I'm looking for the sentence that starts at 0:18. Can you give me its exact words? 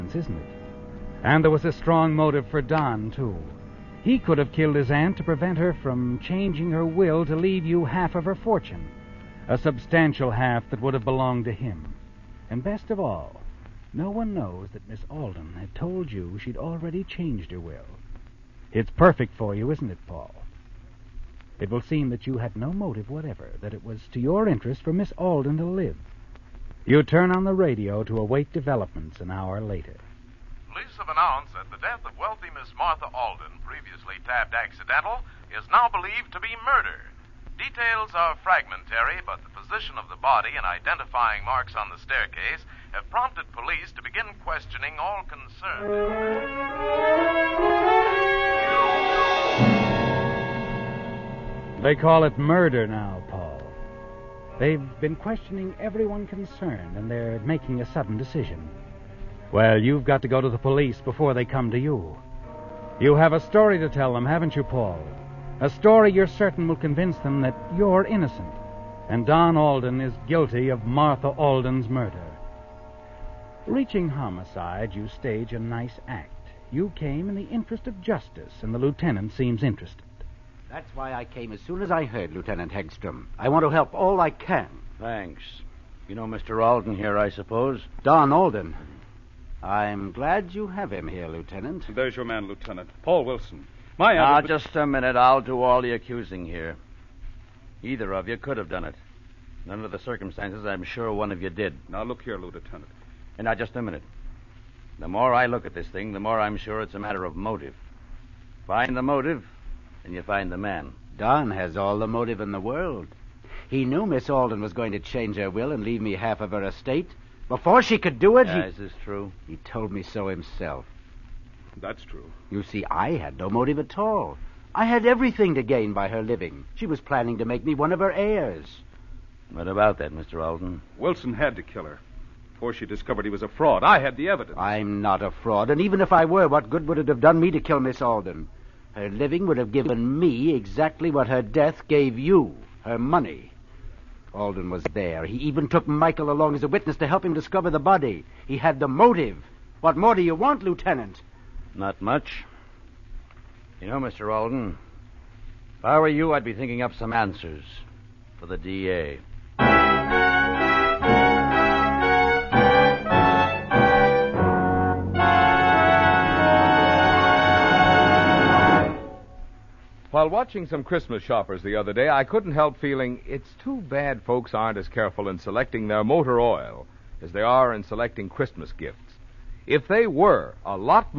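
It's perfect for you, isn't it, Paul?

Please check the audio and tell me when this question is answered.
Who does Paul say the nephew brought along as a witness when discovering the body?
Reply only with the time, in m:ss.
2:25.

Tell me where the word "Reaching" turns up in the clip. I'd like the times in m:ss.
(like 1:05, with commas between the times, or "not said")
1:13.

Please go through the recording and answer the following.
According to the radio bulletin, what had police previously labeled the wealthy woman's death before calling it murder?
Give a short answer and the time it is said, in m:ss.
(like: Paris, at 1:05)
Accidental, at 0:34.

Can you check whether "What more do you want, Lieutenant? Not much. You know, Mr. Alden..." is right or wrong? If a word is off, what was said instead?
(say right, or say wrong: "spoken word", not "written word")
right.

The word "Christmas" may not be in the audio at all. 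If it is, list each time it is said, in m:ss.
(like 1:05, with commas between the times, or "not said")
2:50, 2:58.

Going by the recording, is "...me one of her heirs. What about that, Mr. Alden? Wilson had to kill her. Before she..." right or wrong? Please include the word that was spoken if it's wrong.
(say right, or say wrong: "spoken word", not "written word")
right.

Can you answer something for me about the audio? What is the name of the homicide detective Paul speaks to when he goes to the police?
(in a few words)
Lieutenant Hegstrom.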